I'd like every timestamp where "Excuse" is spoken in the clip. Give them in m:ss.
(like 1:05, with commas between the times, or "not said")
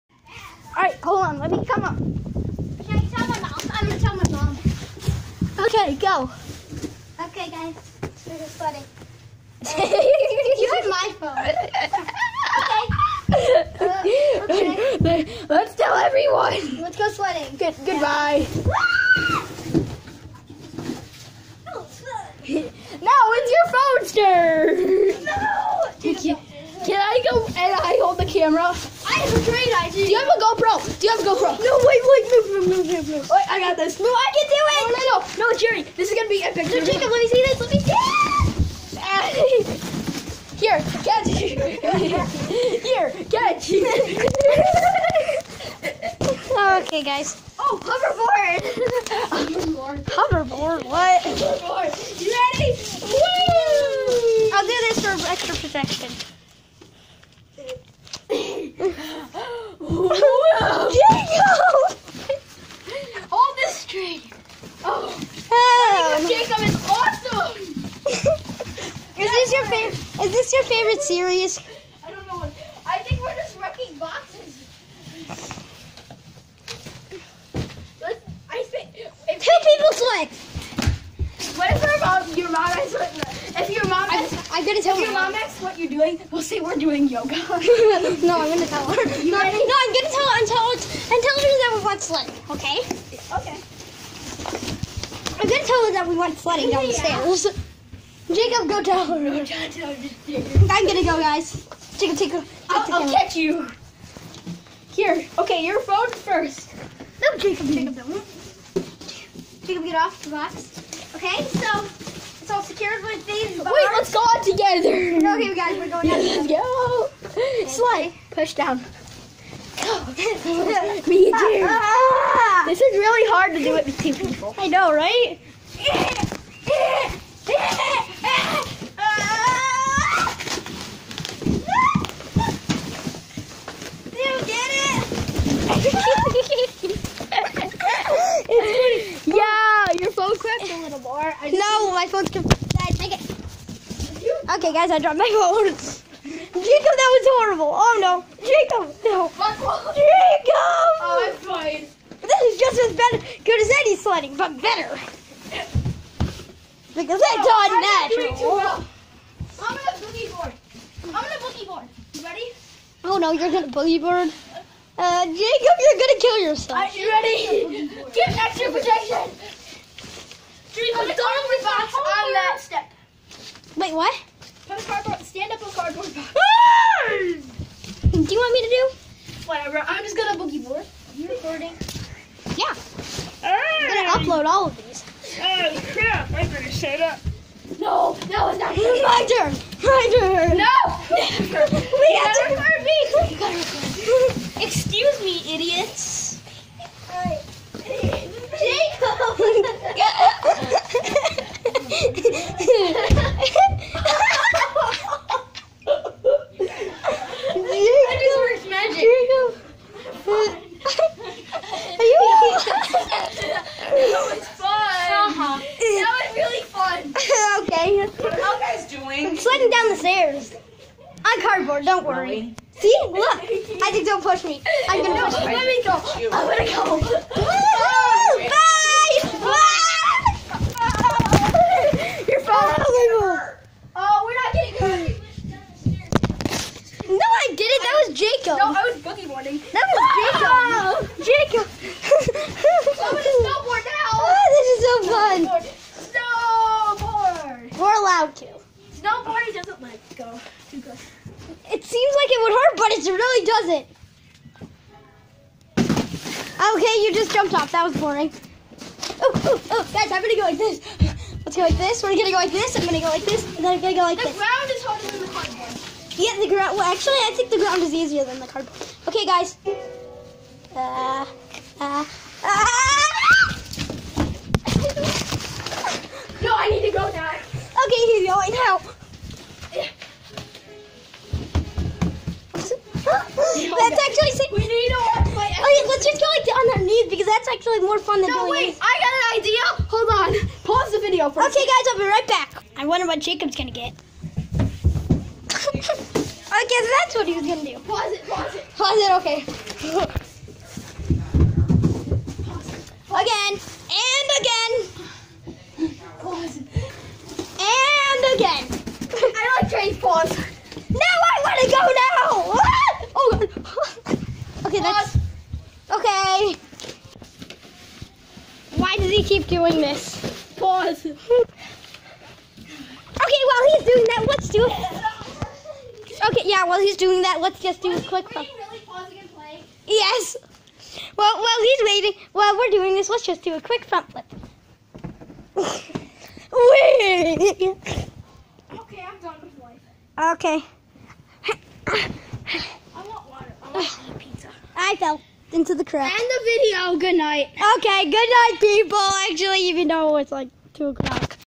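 3:14.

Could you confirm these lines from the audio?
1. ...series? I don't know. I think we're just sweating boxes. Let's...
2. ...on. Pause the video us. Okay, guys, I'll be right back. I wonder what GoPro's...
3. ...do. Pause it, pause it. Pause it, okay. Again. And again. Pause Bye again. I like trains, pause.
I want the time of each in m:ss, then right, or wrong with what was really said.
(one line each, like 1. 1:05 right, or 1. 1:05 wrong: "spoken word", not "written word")
1. 1:11 wrong: "wrecking", not "sweating"
2. 4:50 wrong: "Jacob", not "GoPro"
3. 4:57 wrong: "And", not "Bye".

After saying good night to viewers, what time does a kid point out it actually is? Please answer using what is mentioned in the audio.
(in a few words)
2 o'clock.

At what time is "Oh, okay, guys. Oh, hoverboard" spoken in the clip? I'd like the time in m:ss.
0:46.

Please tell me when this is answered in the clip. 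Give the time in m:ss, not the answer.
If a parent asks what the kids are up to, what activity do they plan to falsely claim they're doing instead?
1:27.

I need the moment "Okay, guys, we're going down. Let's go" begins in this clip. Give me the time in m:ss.
1:55.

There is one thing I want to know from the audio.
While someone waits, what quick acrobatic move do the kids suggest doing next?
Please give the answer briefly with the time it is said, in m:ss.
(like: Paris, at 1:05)
front flip, at 5:33.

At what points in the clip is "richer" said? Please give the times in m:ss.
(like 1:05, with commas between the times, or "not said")
not said.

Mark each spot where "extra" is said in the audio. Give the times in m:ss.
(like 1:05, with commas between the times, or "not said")
0:55, 2:48.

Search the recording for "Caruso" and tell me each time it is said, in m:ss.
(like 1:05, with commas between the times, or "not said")
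not said.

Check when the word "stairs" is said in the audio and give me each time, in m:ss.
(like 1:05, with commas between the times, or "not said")
1:37, 3:40.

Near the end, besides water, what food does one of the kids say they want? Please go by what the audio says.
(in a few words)
pizza.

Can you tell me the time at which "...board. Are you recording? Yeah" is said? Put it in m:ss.
3:00.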